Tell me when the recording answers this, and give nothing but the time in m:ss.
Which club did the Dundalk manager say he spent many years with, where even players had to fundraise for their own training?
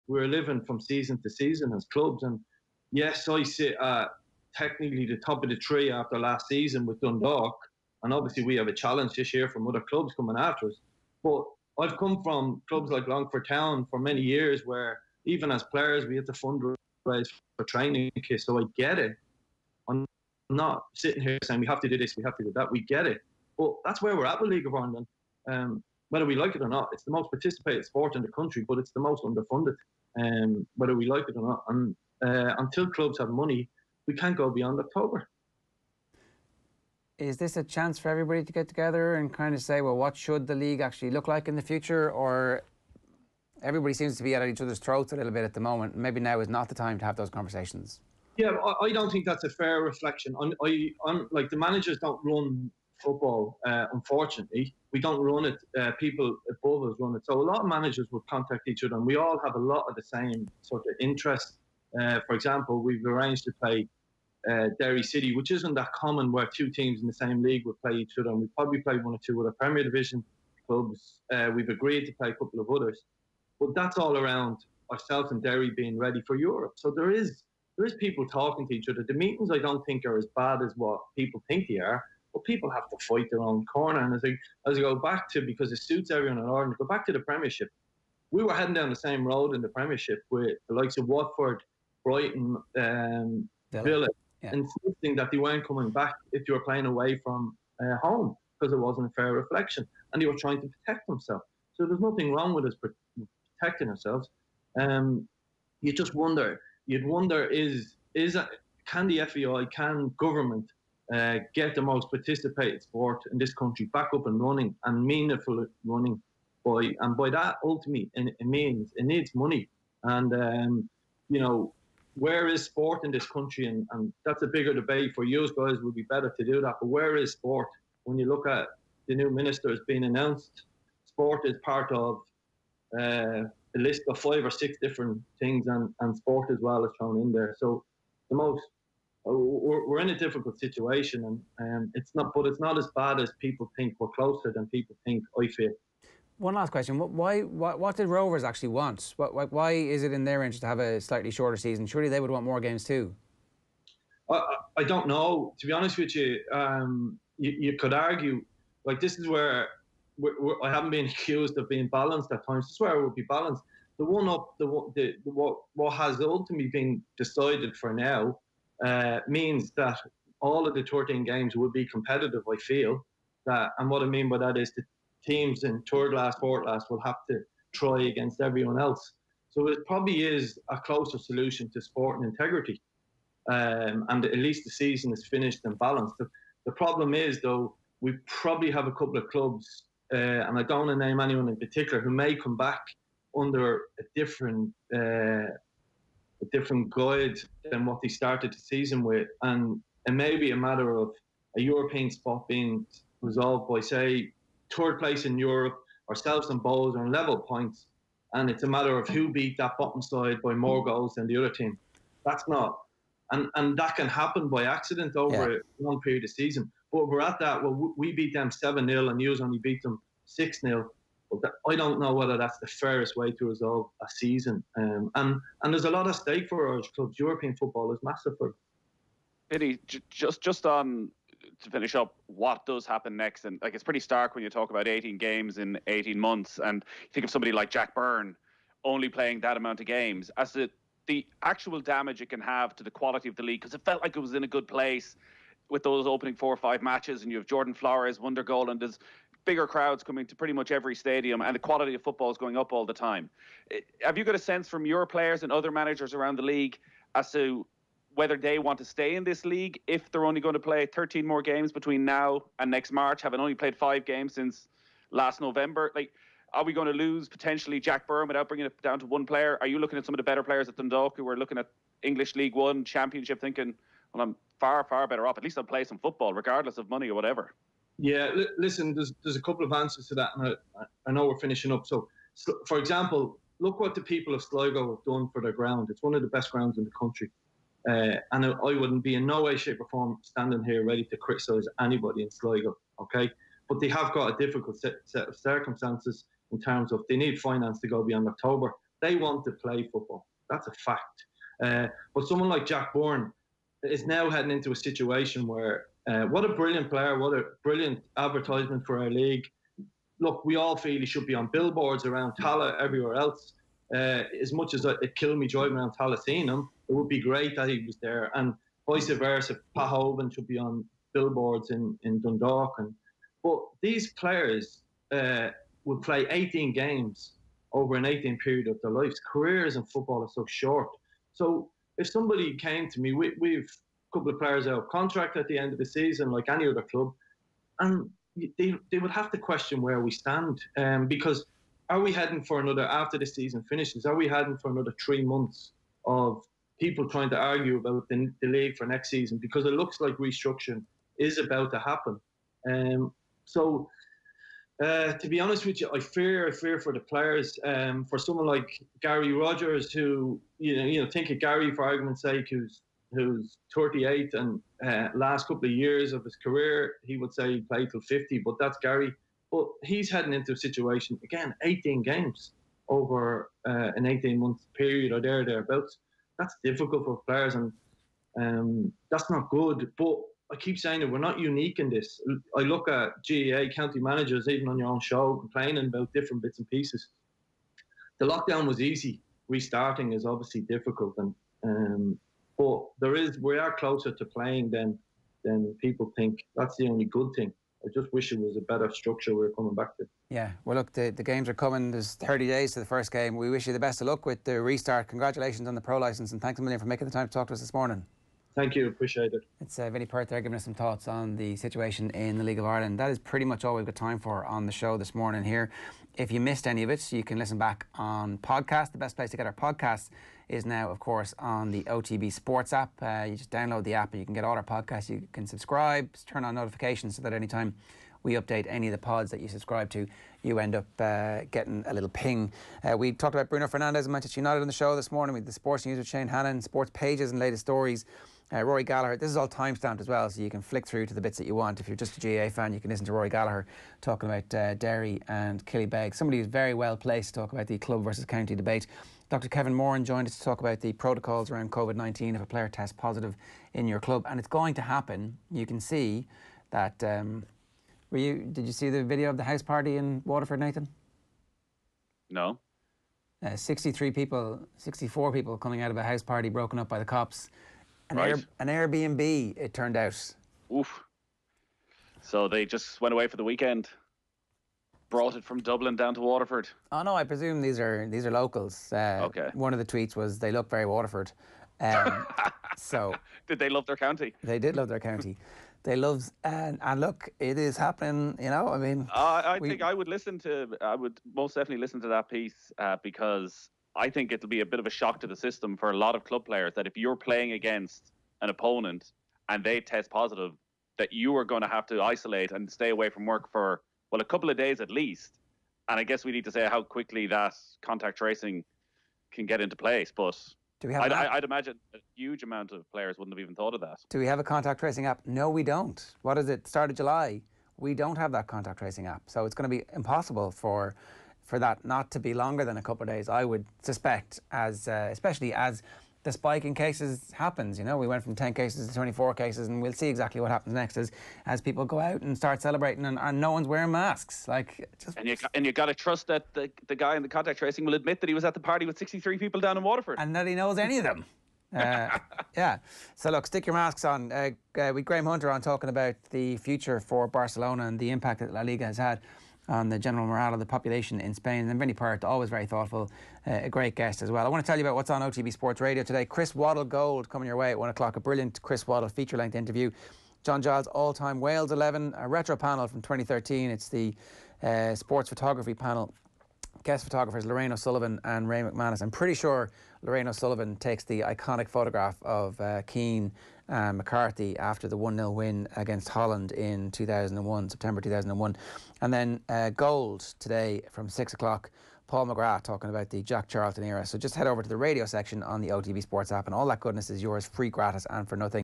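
0:13.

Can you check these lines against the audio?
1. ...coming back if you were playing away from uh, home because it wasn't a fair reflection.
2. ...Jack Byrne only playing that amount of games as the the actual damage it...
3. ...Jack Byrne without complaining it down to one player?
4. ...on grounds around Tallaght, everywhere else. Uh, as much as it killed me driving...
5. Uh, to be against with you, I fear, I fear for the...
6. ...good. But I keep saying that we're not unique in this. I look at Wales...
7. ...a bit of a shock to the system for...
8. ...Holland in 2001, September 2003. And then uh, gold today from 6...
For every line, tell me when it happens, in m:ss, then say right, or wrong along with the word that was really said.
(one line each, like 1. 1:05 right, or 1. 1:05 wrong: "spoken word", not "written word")
1. 1:35 right
2. 3:57 right
3. 4:27 wrong: "bringing", not "complaining"
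4. 5:11 wrong: "billboards", not "grounds"
5. 5:54 wrong: "honest", not "against"
6. 6:19 wrong: "GAA", not "Wales"
7. 8:14 right
8. 9:36 wrong: "2001", not "2003".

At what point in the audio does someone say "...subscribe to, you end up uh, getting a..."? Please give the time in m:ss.
7:09.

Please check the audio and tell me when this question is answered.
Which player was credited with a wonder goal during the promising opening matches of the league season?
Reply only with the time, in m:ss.
4:07.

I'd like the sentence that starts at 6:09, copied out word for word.
But he's heading into a situation, again, 18 games over uh, an 18 month period or there, thereabouts.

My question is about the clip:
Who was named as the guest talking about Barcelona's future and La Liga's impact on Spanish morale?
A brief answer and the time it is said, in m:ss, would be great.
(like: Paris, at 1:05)
Graham Hunter, at 9:05.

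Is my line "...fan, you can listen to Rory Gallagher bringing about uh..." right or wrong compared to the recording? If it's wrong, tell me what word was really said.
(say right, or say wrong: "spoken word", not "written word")
wrong: "talking", not "bringing".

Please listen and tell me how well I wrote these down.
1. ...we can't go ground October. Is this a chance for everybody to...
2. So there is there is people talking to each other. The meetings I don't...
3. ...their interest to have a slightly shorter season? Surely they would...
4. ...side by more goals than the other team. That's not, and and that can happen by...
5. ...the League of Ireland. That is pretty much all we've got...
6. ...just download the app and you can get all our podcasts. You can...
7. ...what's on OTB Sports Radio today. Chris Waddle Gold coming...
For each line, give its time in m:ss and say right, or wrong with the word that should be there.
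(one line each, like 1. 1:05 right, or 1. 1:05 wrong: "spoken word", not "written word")
1. 0:34 wrong: "beyond", not "ground"
2. 1:16 right
3. 2:30 right
4. 3:30 right
5. 6:52 right
6. 7:03 right
7. 9:14 right.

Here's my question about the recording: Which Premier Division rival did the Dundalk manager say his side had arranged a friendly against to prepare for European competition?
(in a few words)
Derry City.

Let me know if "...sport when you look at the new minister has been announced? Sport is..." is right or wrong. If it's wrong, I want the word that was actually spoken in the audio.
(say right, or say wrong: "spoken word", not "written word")
right.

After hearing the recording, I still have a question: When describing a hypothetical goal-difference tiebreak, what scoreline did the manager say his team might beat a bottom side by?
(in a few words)
7-0.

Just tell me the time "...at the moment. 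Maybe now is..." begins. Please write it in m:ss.
0:45.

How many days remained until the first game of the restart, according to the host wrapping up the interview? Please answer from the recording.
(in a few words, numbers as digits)
30.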